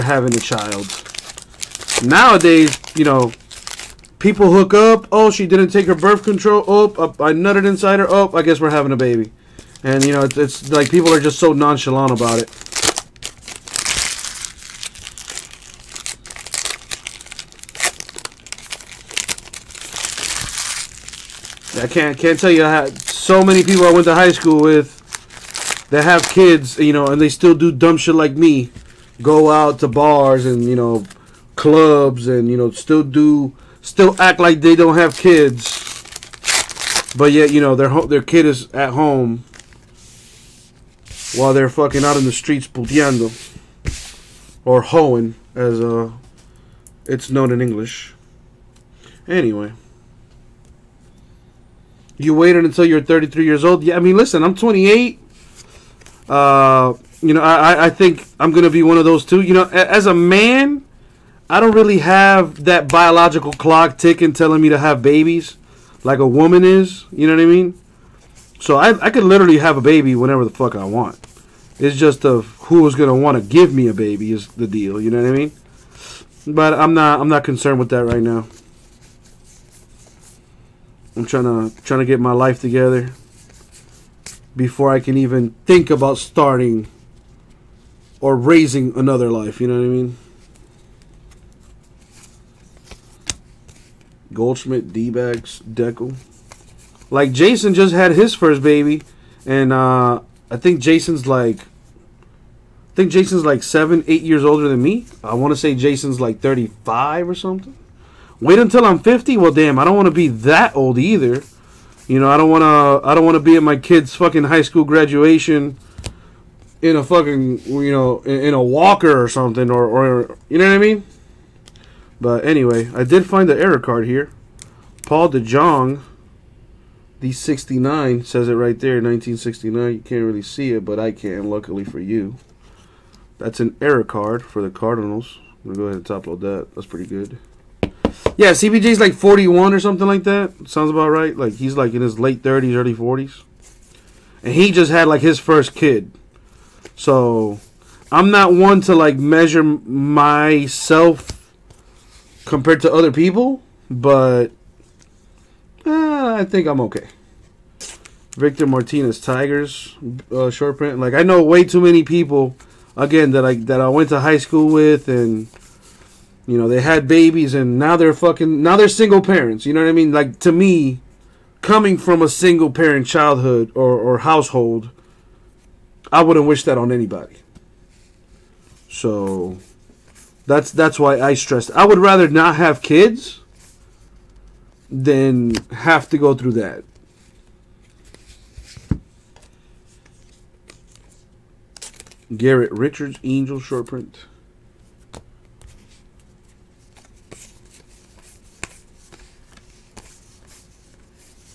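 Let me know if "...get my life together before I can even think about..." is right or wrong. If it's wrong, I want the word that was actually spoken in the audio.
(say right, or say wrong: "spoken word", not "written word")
right.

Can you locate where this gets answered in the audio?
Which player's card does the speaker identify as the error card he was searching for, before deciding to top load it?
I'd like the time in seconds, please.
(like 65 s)
125 s.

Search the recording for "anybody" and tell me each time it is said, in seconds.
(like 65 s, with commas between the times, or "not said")
176 s.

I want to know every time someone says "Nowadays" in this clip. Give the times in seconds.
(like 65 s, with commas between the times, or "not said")
2 s.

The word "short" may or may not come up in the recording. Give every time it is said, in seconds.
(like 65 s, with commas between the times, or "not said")
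160 s, 193 s.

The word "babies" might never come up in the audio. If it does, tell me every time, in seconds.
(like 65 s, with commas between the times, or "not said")
65 s, 167 s.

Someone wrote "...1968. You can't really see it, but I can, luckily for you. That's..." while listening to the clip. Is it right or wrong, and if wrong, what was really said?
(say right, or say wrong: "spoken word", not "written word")
wrong: "1969", not "1968".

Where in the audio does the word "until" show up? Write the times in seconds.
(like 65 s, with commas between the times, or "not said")
52 s, 108 s.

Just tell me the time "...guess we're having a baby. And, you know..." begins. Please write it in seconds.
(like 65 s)
8 s.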